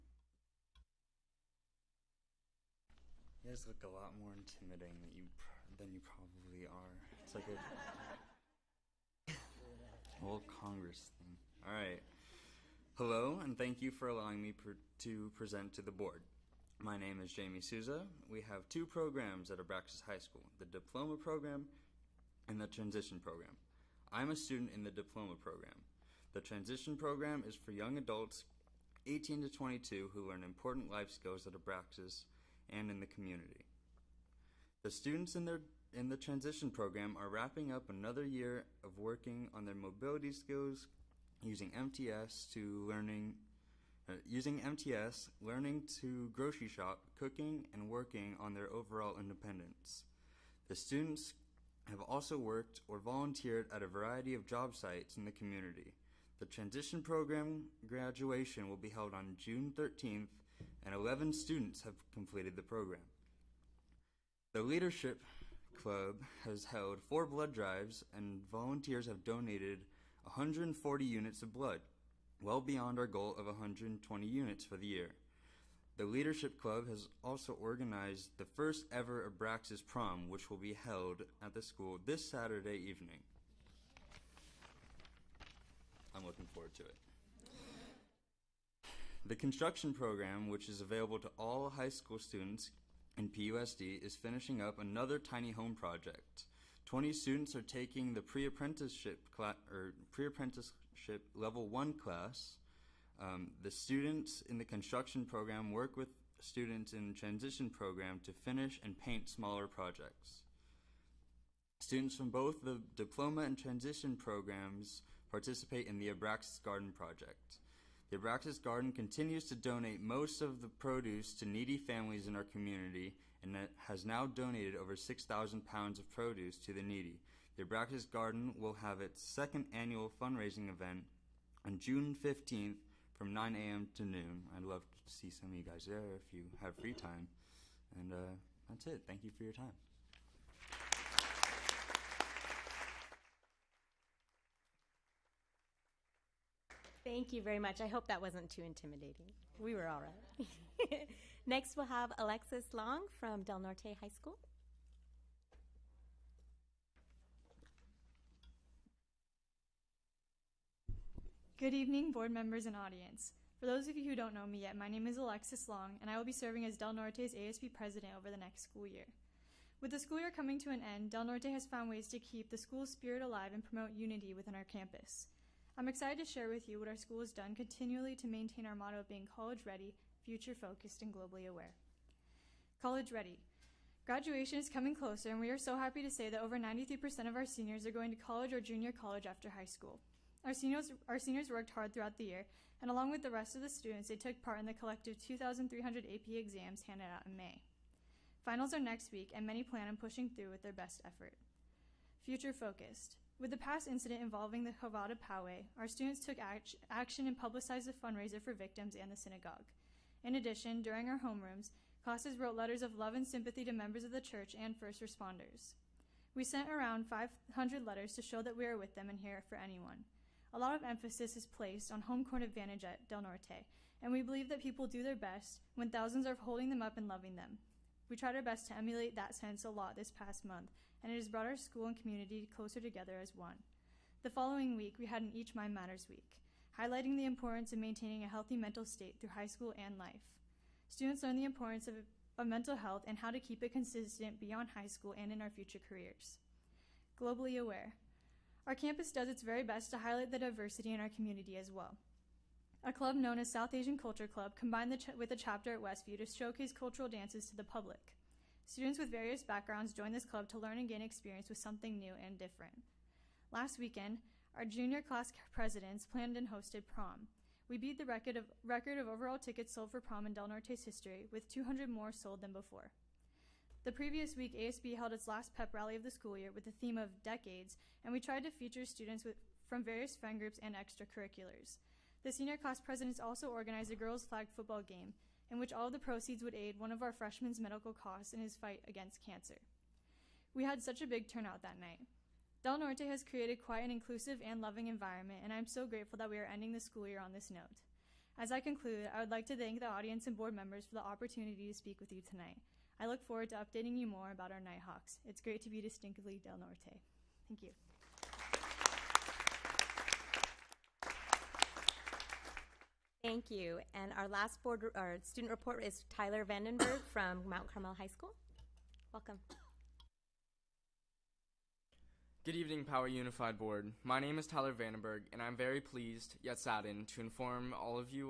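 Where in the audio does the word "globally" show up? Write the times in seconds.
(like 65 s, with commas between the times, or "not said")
181 s, 247 s.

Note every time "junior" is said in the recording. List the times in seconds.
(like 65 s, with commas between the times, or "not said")
188 s, 264 s.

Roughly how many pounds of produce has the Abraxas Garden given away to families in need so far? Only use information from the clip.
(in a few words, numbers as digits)
6,000.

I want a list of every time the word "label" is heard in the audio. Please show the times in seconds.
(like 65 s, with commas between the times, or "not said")
not said.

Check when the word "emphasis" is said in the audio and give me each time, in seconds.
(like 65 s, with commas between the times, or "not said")
220 s.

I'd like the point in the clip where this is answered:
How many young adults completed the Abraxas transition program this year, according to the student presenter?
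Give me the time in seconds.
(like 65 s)
60 s.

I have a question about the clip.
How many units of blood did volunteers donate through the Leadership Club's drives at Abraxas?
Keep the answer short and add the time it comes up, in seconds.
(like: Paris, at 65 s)
140, at 70 s.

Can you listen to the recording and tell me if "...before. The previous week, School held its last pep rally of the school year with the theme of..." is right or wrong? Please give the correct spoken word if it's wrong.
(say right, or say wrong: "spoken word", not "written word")
wrong: "ASB", not "School".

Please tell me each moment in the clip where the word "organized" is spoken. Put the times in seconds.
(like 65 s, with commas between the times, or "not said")
77 s, 283 s.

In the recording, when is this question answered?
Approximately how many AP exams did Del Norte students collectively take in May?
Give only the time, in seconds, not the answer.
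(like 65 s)
195 s.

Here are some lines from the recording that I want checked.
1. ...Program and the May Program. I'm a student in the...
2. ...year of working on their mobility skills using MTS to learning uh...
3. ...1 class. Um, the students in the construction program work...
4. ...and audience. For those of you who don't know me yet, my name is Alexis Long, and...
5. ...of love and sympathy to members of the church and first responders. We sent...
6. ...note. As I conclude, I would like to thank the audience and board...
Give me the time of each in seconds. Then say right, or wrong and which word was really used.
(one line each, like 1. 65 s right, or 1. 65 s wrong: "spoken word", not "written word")
1. 21 s wrong: "Transition", not "May"
2. 38 s right
3. 101 s right
4. 162 s right
5. 212 s right
6. 297 s right.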